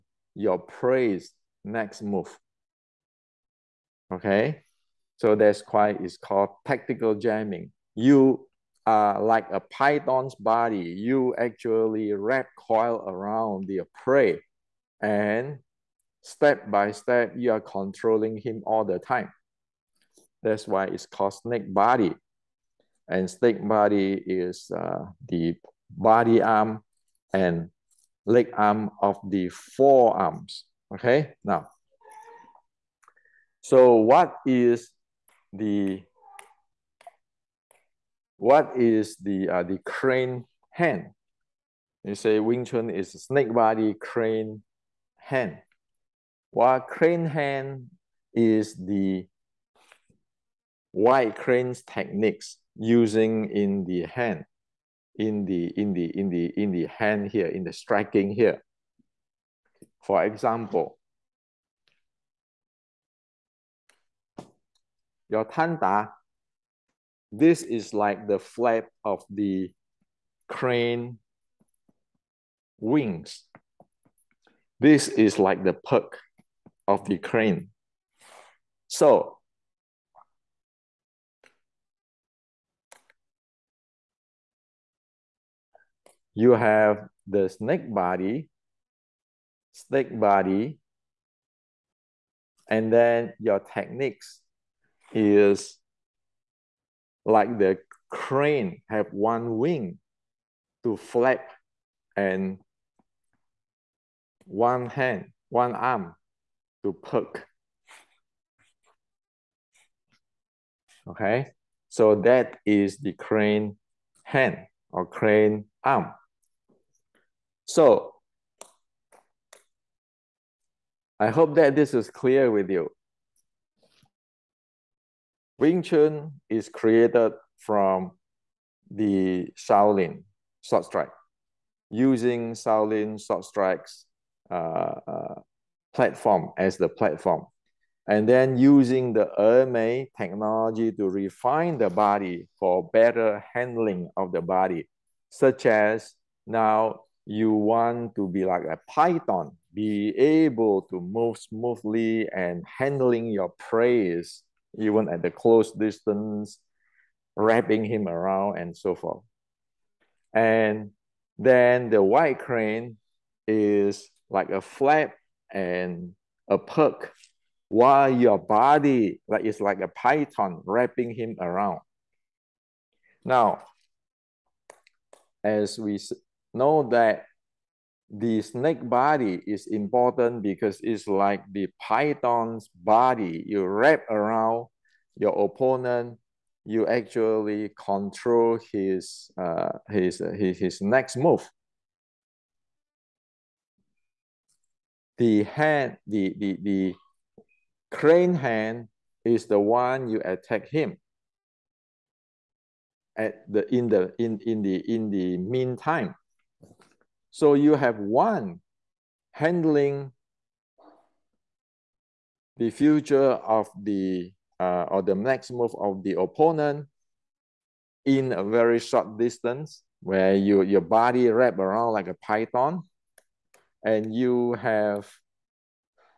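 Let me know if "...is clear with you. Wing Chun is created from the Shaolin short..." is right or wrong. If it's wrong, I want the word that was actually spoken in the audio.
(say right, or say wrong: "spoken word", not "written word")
right.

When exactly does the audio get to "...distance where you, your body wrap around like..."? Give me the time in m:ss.
3:39.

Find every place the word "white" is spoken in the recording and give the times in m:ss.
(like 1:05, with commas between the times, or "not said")
0:50, 2:42.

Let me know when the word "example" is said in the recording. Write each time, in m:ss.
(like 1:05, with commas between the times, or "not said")
1:00.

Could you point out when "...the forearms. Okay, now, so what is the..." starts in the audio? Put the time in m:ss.
0:29.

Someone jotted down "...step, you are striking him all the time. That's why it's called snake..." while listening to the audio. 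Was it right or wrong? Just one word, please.
wrong.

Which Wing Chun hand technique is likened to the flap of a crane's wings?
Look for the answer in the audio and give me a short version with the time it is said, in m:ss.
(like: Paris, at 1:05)
Tanda, at 1:05.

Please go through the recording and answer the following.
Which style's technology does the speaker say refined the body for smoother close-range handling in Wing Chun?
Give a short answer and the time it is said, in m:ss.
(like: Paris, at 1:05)
Ermei, at 2:19.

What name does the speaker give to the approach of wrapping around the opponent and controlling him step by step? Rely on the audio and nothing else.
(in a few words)
Tactical jamming.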